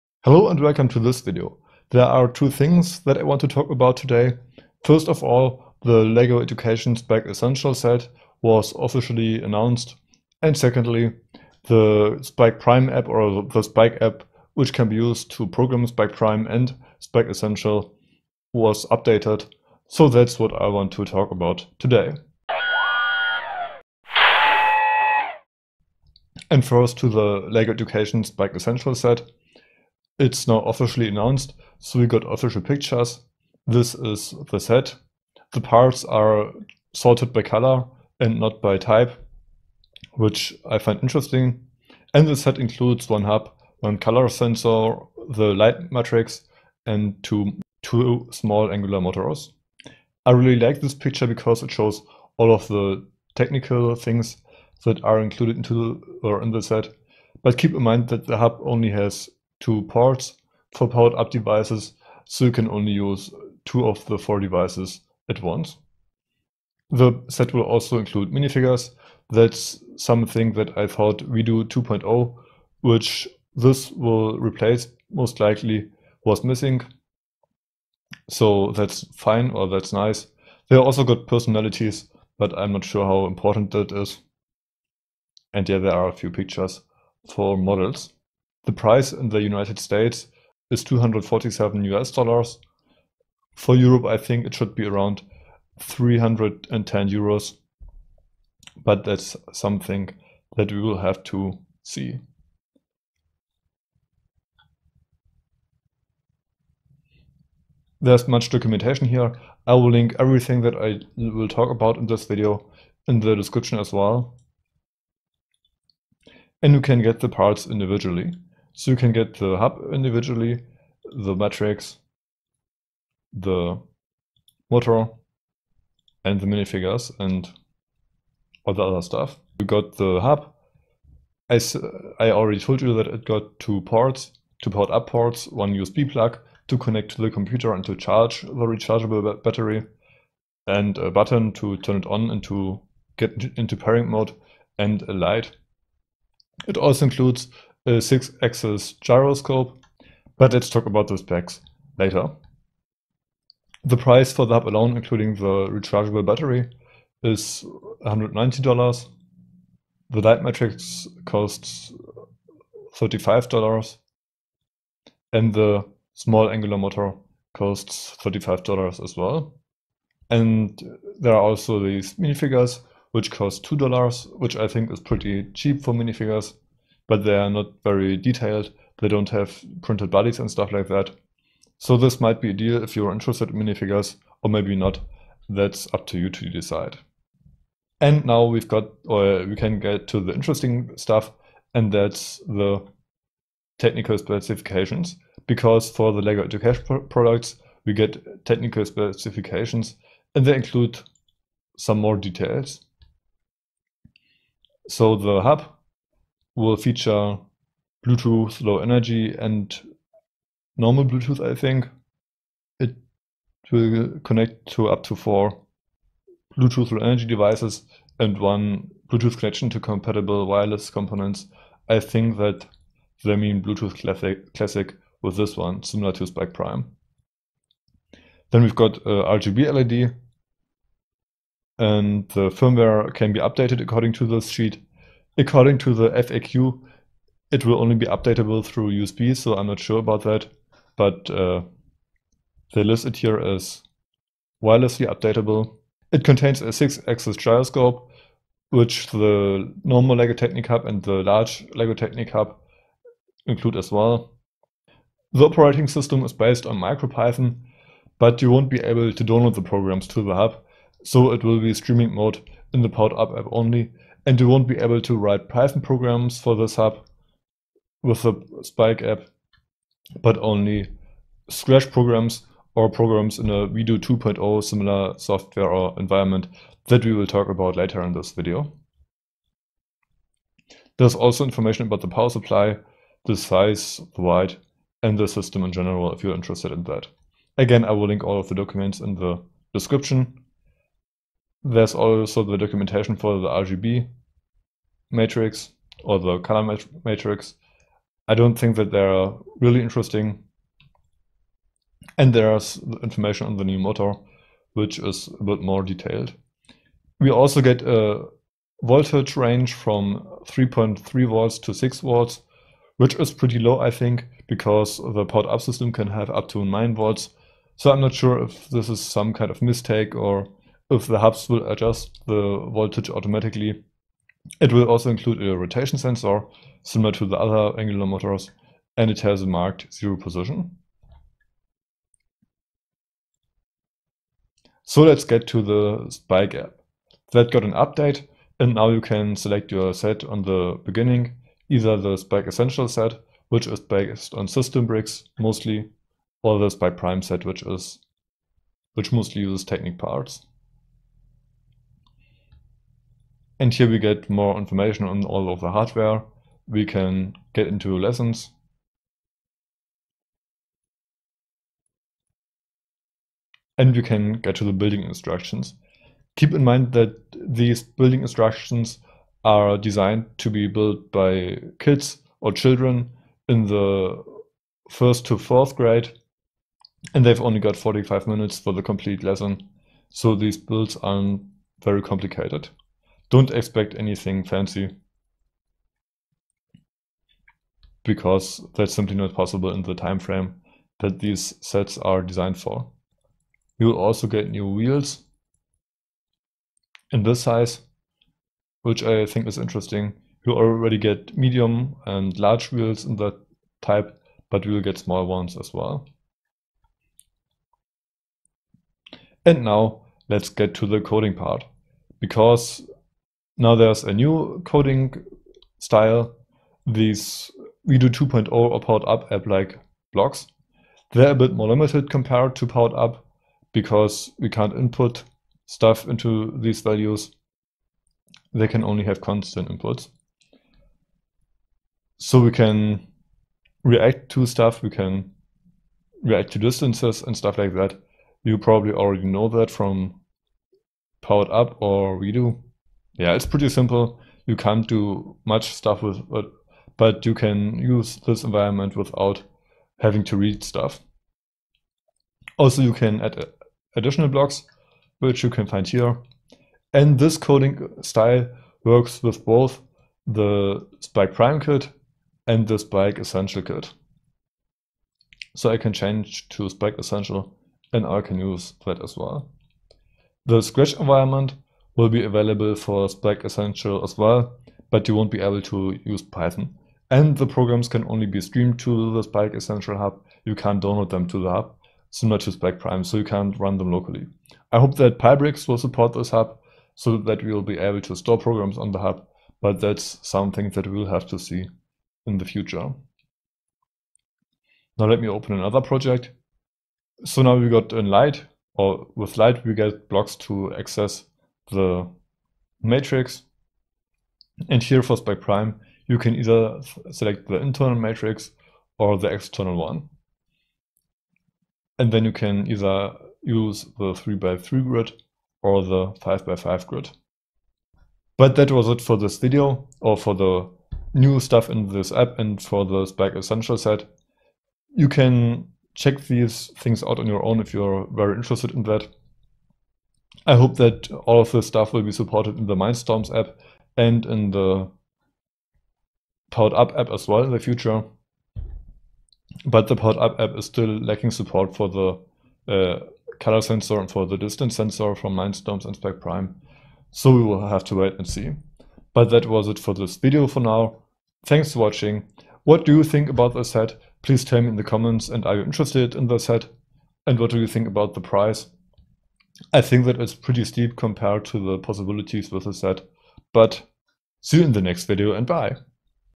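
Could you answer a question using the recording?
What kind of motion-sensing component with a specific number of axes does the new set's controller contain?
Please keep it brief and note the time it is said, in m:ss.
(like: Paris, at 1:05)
six-axis gyroscope, at 4:06.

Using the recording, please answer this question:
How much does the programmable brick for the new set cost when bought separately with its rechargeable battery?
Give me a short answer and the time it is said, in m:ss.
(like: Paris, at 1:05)
$190, at 2:38.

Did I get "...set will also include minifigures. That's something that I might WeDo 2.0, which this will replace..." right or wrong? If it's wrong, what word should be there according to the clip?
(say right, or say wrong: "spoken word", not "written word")
wrong: "thought", not "might".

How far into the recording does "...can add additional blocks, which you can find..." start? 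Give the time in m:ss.
7:32.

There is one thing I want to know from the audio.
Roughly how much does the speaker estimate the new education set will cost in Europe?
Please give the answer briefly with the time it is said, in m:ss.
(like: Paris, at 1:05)
310 euros, at 1:35.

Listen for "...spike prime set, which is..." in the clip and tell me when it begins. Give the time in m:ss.
5:46.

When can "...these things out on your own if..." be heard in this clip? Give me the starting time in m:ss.
8:46.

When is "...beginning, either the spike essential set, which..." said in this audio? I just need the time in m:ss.
5:40.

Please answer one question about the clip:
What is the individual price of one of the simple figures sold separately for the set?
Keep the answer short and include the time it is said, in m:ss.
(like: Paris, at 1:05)
$2, at 2:53.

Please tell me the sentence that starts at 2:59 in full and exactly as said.
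They don't have printed bodies and stuff like that.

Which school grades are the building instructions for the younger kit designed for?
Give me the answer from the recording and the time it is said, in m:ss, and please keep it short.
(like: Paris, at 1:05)
first to fourth grade, at 6:14.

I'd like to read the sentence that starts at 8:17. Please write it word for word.
So now we got in Light, or with Light we get blocks to access the matrix.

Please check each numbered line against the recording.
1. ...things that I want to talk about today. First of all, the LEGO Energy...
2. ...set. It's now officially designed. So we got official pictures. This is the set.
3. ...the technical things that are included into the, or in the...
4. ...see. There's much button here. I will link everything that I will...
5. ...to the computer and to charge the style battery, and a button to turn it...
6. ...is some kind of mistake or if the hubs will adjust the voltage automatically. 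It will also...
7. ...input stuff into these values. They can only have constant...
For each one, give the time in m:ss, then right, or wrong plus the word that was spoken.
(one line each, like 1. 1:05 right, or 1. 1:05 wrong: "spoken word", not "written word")
1. 0:02 wrong: "Education", not "Energy"
2. 0:28 wrong: "announced", not "designed"
3. 0:52 right
4. 1:41 wrong: "documentation", not "button"
5. 2:17 wrong: "rechargeable", not "style"
6. 5:18 right
7. 7:04 right.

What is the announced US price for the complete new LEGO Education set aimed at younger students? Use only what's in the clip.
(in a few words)
247 US dollars.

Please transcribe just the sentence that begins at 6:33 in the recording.
You will also get new wheels in this size, which I think is interesting.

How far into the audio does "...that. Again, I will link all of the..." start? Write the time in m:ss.
4:46.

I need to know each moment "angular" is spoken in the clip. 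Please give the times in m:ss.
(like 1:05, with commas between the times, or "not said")
0:48, 2:46, 5:27.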